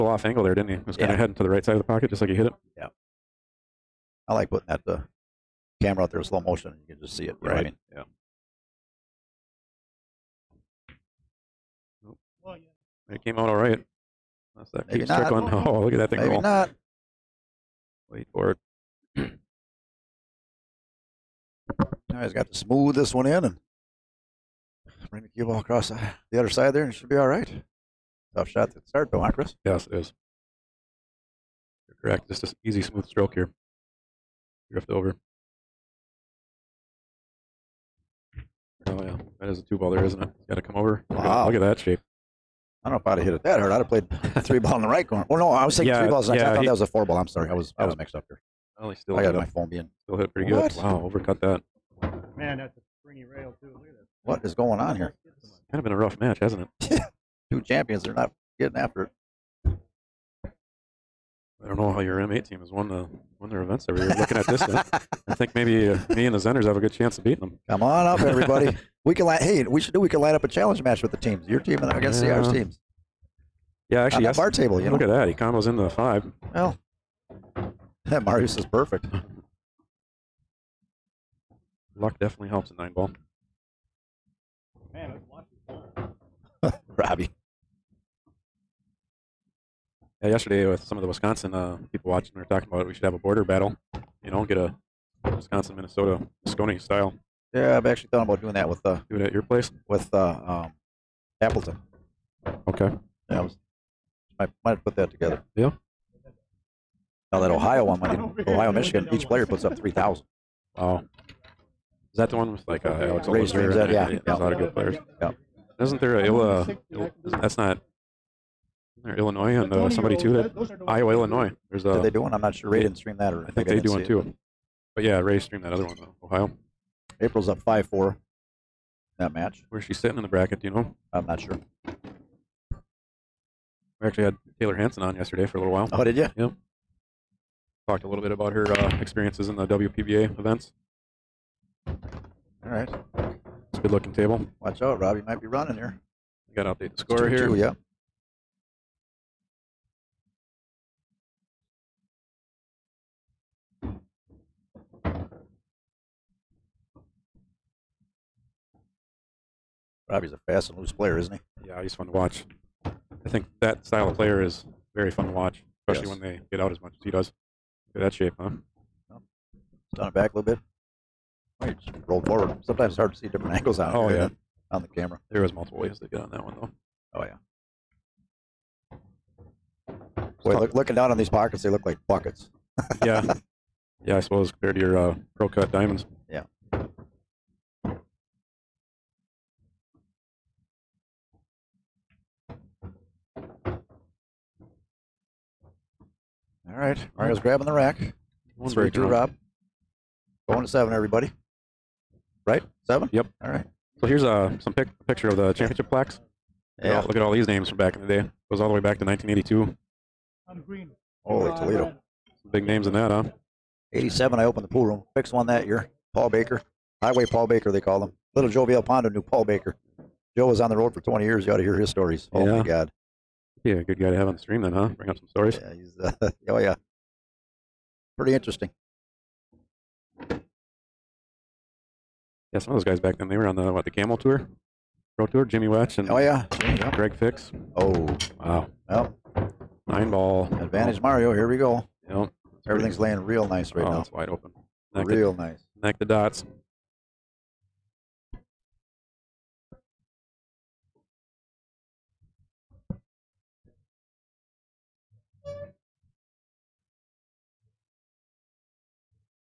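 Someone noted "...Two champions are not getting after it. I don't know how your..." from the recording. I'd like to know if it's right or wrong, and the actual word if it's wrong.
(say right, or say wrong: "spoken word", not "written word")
right.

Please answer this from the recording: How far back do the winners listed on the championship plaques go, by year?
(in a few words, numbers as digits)
1982.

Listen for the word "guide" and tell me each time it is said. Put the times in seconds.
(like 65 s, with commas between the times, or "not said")
not said.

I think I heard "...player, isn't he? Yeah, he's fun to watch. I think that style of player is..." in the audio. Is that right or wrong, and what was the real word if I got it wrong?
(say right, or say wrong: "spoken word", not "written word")
right.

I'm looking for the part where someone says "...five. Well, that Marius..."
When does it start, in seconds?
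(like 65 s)
75 s.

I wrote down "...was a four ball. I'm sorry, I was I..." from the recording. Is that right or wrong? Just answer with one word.
right.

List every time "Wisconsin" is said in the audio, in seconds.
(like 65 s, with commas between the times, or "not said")
91 s, 95 s.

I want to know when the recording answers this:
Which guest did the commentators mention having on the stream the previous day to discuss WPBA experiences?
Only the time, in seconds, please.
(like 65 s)
134 s.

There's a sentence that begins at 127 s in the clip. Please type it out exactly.
April's up five four that match.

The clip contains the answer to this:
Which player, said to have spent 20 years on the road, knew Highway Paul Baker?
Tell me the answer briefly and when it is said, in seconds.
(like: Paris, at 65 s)
Little Joe Villalpando, at 218 s.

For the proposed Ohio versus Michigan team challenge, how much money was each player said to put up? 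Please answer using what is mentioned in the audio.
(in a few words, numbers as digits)
3,000.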